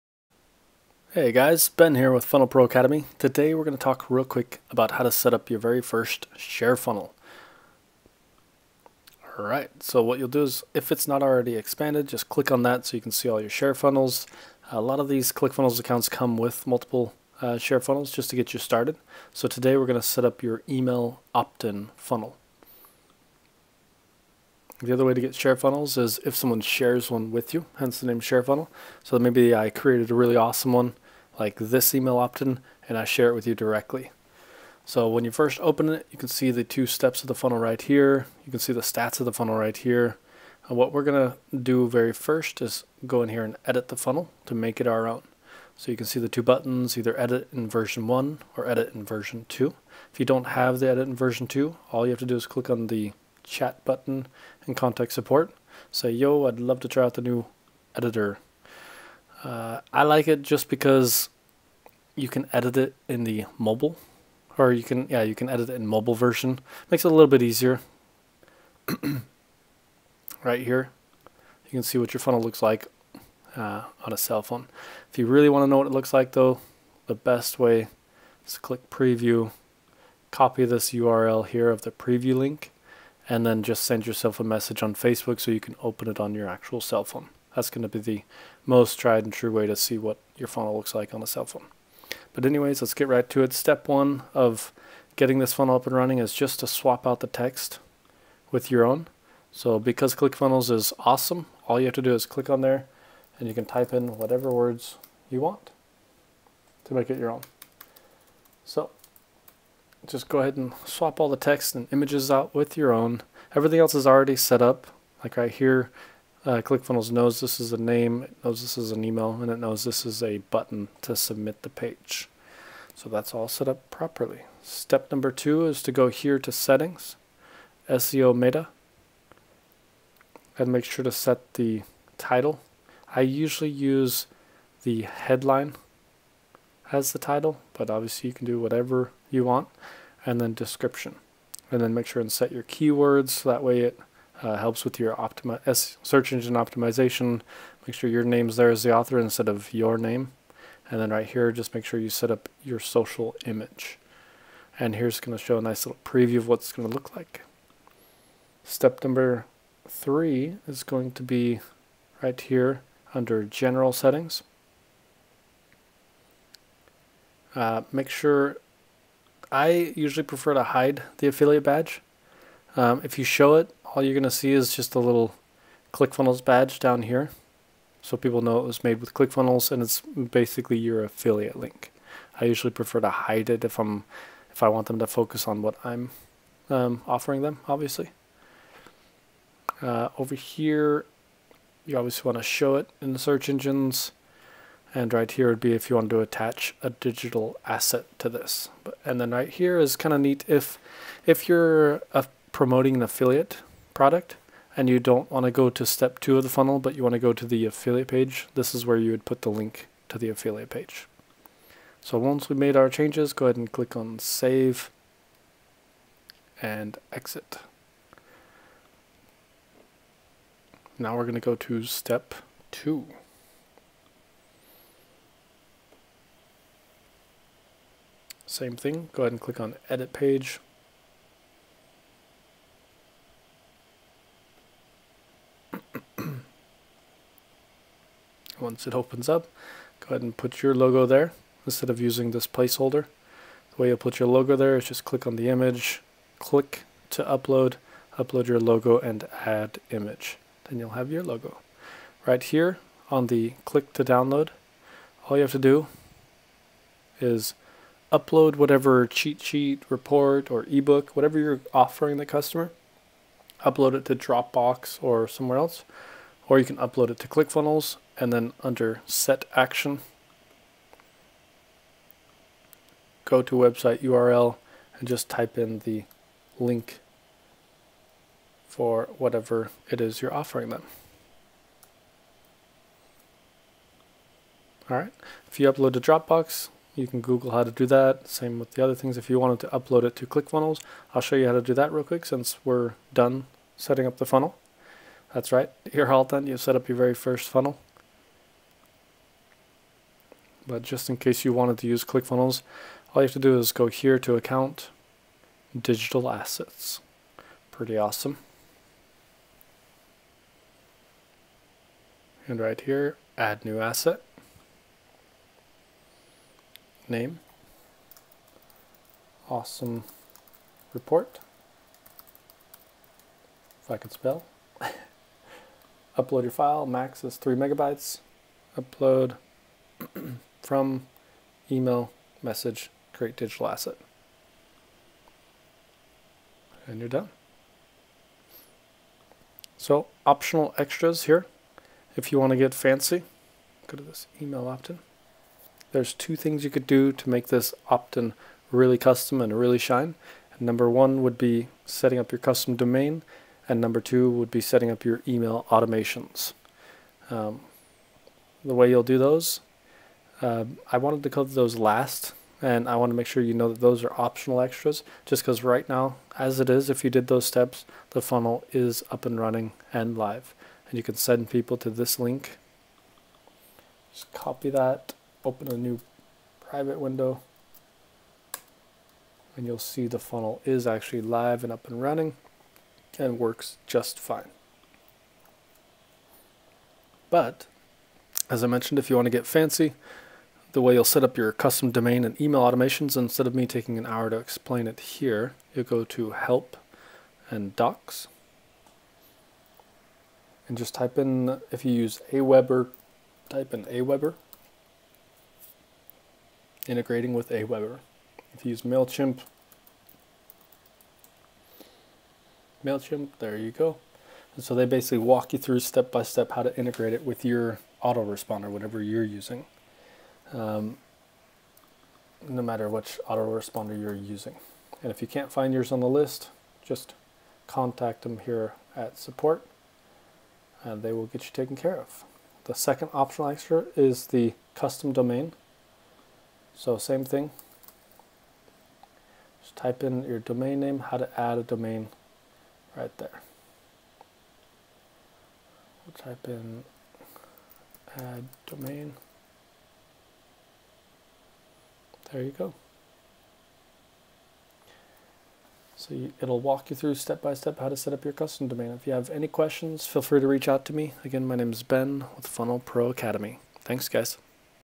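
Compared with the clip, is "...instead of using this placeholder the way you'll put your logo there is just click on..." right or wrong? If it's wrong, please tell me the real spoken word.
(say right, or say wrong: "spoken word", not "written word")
right.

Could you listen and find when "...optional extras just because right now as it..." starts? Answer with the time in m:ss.
6:04.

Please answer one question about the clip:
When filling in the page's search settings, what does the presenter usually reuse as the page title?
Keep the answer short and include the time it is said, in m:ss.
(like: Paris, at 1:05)
The headline, at 2:14.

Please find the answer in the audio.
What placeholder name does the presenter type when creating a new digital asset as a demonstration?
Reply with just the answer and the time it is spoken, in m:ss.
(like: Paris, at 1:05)
Awesome Report, at 5:19.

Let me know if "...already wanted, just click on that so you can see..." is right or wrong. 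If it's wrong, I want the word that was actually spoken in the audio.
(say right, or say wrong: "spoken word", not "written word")
wrong: "expanded", not "wanted".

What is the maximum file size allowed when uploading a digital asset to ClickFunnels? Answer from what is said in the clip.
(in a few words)
3 megabytes.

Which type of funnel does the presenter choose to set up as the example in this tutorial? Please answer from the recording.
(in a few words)
Email opt-in funnel.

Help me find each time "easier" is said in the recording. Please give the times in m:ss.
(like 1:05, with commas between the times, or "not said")
1:07.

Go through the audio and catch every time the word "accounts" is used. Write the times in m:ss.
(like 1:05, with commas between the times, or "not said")
0:15, 5:04.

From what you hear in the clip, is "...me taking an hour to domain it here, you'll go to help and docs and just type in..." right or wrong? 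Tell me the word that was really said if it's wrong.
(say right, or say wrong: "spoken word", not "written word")
wrong: "explain", not "domain".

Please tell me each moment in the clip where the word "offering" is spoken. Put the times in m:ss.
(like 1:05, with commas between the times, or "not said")
3:07, 4:21, 4:40.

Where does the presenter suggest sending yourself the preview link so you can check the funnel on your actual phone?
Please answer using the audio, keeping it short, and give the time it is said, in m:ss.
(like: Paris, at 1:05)
Facebook, at 1:24.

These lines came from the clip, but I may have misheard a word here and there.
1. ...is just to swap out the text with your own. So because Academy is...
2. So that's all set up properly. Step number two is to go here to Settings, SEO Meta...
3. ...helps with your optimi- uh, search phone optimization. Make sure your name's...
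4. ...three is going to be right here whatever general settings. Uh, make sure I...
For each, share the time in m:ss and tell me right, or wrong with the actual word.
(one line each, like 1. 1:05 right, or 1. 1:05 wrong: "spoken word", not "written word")
1. 1:36 wrong: "ClickFunnels", not "Academy"
2. 2:02 right
3. 2:24 wrong: "engine", not "phone"
4. 2:39 wrong: "under", not "whatever".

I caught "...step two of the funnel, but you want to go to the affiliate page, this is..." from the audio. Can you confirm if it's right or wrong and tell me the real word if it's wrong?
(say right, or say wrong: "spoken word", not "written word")
right.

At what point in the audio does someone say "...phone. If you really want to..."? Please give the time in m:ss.
1:14.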